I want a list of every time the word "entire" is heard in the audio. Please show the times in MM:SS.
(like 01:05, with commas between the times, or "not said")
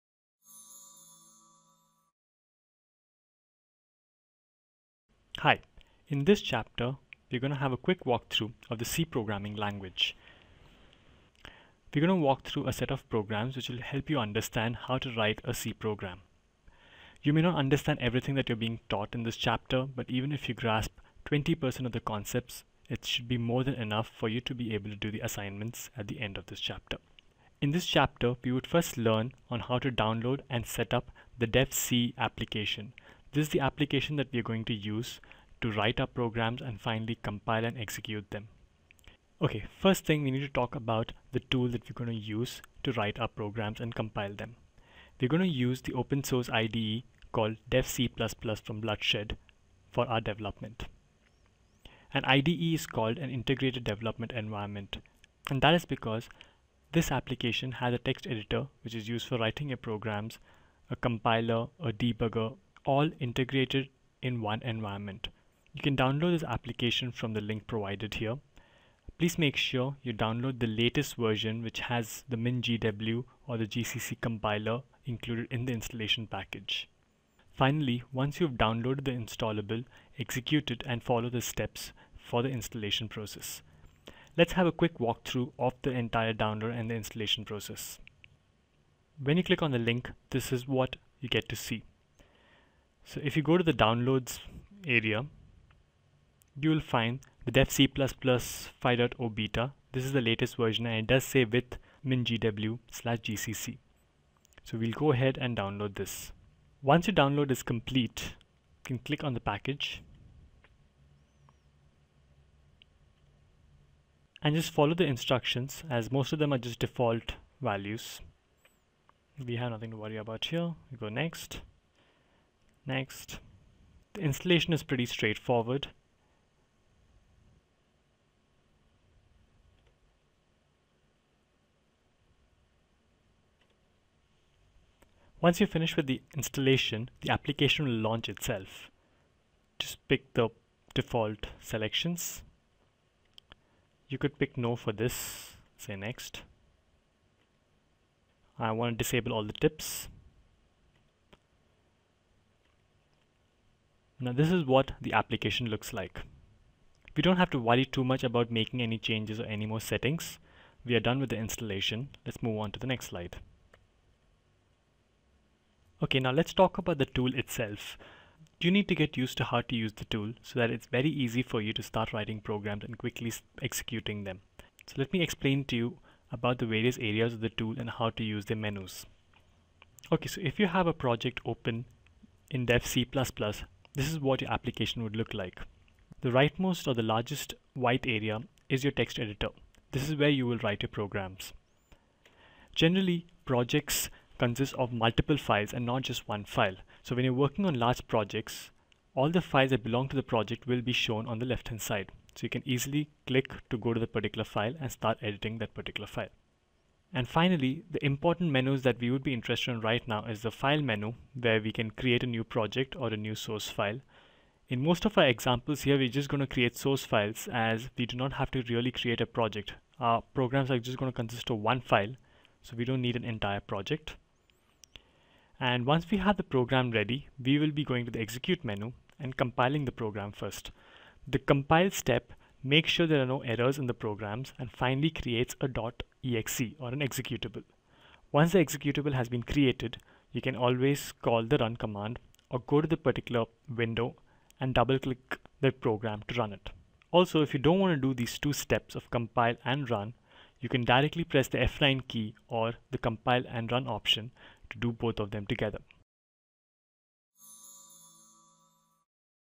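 01:25, 03:43.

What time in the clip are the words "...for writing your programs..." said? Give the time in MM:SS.
00:59.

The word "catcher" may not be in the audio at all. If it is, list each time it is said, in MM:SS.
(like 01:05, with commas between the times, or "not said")
not said.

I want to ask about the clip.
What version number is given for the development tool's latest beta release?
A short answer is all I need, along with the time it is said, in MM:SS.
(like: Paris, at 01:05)
5.0, at 01:37.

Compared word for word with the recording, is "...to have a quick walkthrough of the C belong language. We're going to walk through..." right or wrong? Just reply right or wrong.
wrong.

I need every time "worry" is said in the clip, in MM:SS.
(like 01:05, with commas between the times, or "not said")
01:59, 02:37.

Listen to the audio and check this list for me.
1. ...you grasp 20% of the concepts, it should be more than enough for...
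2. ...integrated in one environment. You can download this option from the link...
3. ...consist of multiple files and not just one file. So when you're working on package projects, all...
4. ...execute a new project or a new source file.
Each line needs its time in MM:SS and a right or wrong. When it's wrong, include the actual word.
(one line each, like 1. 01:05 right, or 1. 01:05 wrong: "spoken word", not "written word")
1. 00:20 right
2. 01:03 wrong: "application", not "option"
3. 03:14 wrong: "large", not "package"
4. 03:31 wrong: "create", not "execute".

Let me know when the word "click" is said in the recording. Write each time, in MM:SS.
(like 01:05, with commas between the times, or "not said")
01:29, 01:48, 03:23, 04:04.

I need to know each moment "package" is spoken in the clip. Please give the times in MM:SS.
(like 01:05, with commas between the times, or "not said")
01:16, 01:49.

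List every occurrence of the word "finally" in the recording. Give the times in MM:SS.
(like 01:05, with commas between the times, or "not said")
00:36, 01:17, 03:27, 03:54.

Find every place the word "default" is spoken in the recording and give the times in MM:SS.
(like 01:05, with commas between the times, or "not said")
01:56, 02:20.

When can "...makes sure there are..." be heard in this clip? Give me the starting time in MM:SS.
03:52.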